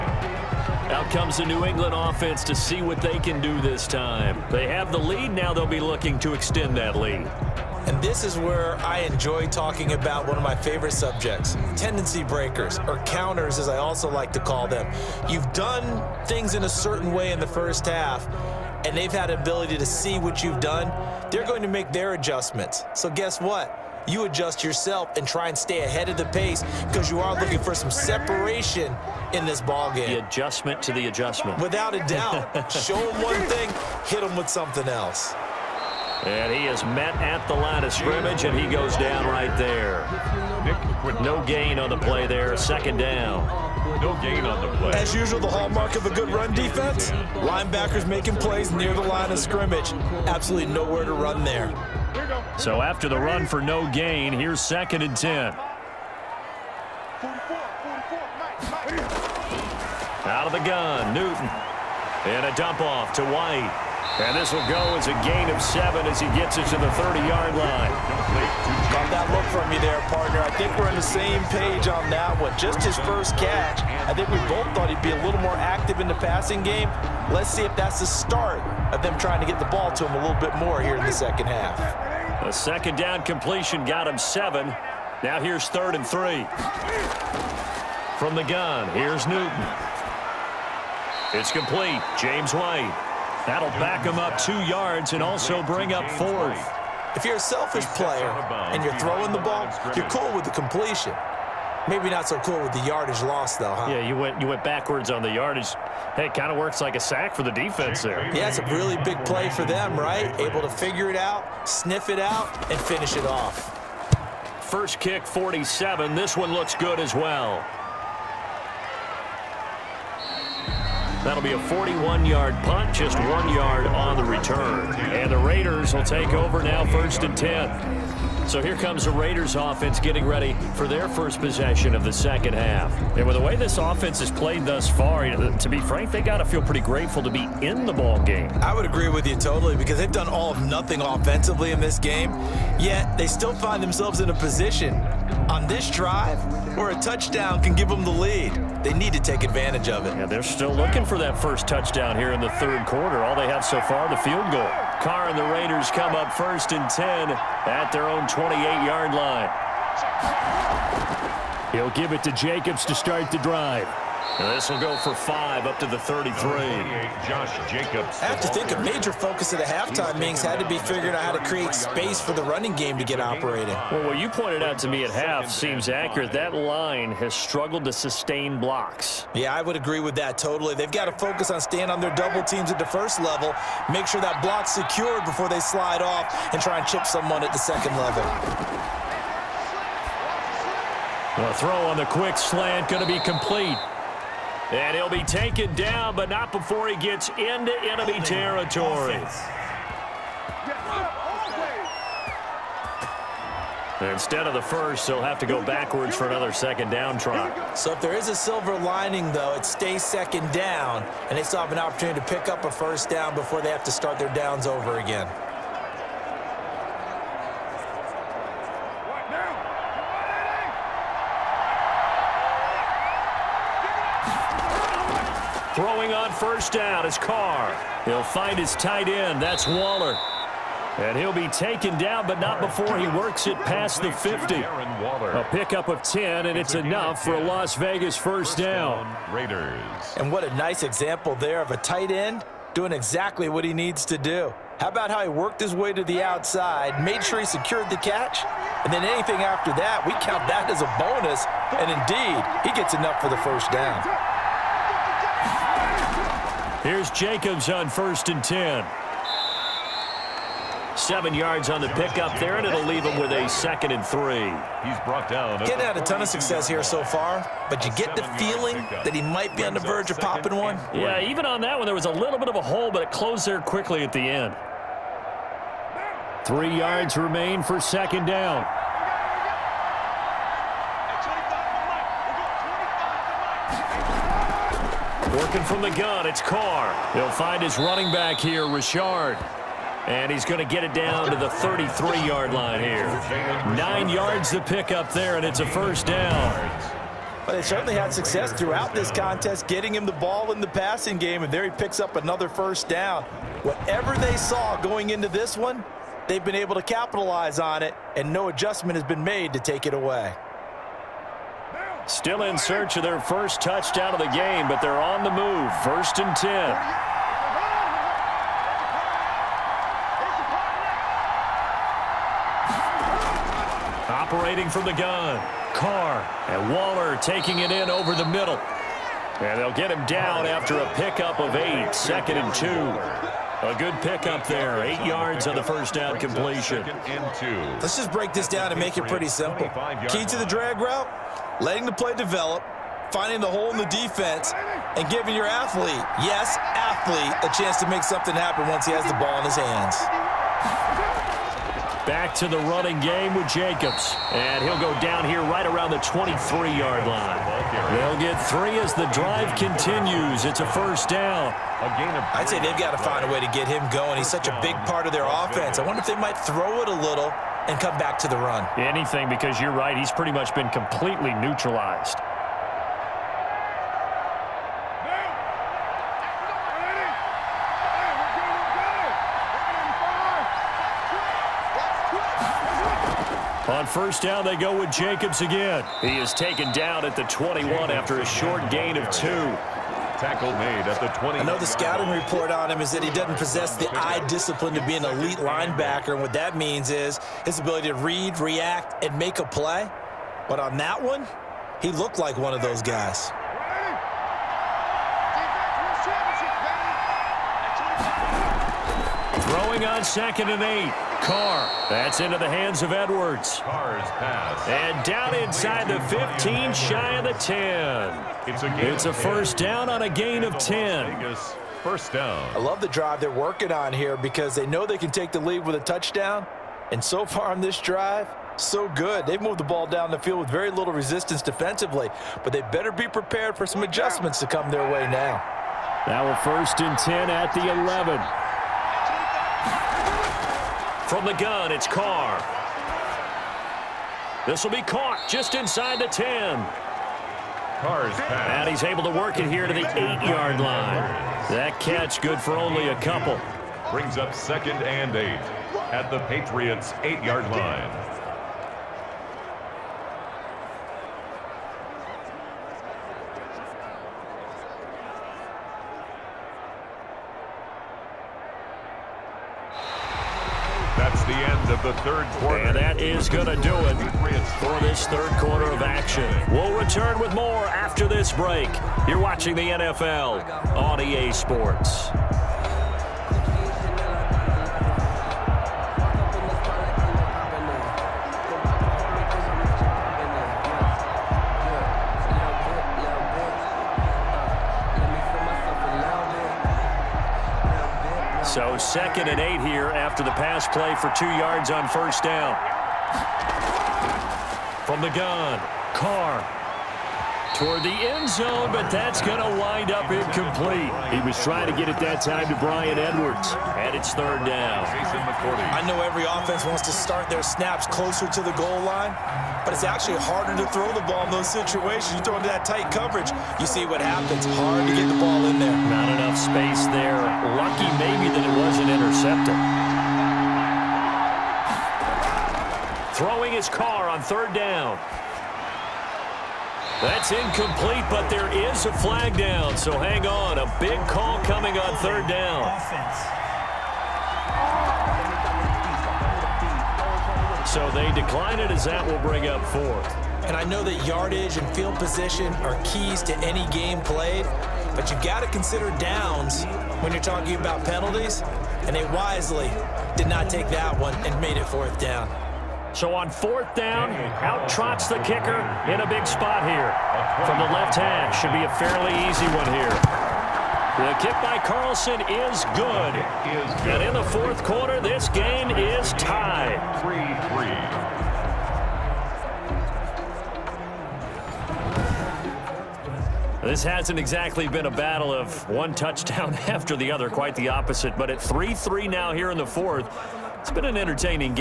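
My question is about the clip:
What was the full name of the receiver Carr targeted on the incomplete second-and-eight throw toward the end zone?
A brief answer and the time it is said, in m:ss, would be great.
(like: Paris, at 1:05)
Bryan Edwards, at 8:32.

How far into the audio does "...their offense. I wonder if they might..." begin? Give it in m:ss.
6:05.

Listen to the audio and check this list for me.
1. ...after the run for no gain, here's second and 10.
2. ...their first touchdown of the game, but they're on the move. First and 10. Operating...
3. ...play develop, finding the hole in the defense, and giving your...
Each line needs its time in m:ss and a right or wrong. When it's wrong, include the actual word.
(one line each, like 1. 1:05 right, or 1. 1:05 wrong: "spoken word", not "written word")
1. 0:52 right
2. 5:13 right
3. 5:41 right.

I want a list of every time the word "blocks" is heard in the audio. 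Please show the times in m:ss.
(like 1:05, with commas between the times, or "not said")
2:58, 3:04.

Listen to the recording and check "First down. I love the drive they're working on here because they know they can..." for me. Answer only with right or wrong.
right.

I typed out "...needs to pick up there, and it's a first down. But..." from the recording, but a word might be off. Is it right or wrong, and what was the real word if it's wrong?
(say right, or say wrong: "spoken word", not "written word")
wrong: "yards", not "needs".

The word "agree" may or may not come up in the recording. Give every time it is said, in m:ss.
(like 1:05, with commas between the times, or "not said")
2:18, 2:59.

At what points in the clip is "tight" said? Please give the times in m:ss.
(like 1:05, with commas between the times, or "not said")
3:48, 4:01, 8:42.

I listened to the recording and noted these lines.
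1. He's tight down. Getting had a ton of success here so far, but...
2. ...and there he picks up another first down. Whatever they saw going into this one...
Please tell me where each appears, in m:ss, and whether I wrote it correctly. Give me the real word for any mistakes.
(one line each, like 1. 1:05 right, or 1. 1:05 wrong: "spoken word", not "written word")
1. 4:24 wrong: "brought", not "tight"
2. 5:01 right.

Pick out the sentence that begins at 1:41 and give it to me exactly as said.
Maybe not so cool with the yardage loss, though, huh?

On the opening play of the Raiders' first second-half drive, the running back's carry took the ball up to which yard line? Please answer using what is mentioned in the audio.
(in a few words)
33.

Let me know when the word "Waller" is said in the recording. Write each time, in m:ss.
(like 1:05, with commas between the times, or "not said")
3:49, 5:26.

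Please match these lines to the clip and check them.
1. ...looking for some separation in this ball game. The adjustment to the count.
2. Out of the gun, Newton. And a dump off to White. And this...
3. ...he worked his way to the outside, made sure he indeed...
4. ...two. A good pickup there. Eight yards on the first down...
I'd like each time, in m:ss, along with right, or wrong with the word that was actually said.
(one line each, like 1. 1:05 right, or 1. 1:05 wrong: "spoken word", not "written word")
1. 0:27 wrong: "adjustment", not "count"
2. 1:00 right
3. 4:05 wrong: "secured", not "indeed"
4. 5:32 right.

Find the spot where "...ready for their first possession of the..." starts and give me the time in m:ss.
2:10.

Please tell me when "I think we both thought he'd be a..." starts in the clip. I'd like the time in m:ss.
1:14.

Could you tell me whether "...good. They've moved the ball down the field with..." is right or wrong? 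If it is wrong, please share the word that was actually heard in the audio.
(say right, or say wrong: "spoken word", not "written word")
right.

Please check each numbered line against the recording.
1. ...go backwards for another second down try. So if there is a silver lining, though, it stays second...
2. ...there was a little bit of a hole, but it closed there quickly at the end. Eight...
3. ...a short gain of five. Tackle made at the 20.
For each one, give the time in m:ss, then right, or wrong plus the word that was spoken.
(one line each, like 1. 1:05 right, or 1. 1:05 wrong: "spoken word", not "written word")
1. 3:25 right
2. 4:31 wrong: "Three", not "Eight"
3. 6:28 wrong: "two", not "five".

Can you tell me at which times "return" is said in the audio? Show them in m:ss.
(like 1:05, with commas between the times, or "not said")
2:04, 7:56.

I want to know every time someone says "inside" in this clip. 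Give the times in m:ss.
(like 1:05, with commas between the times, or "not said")
6:55, 7:25.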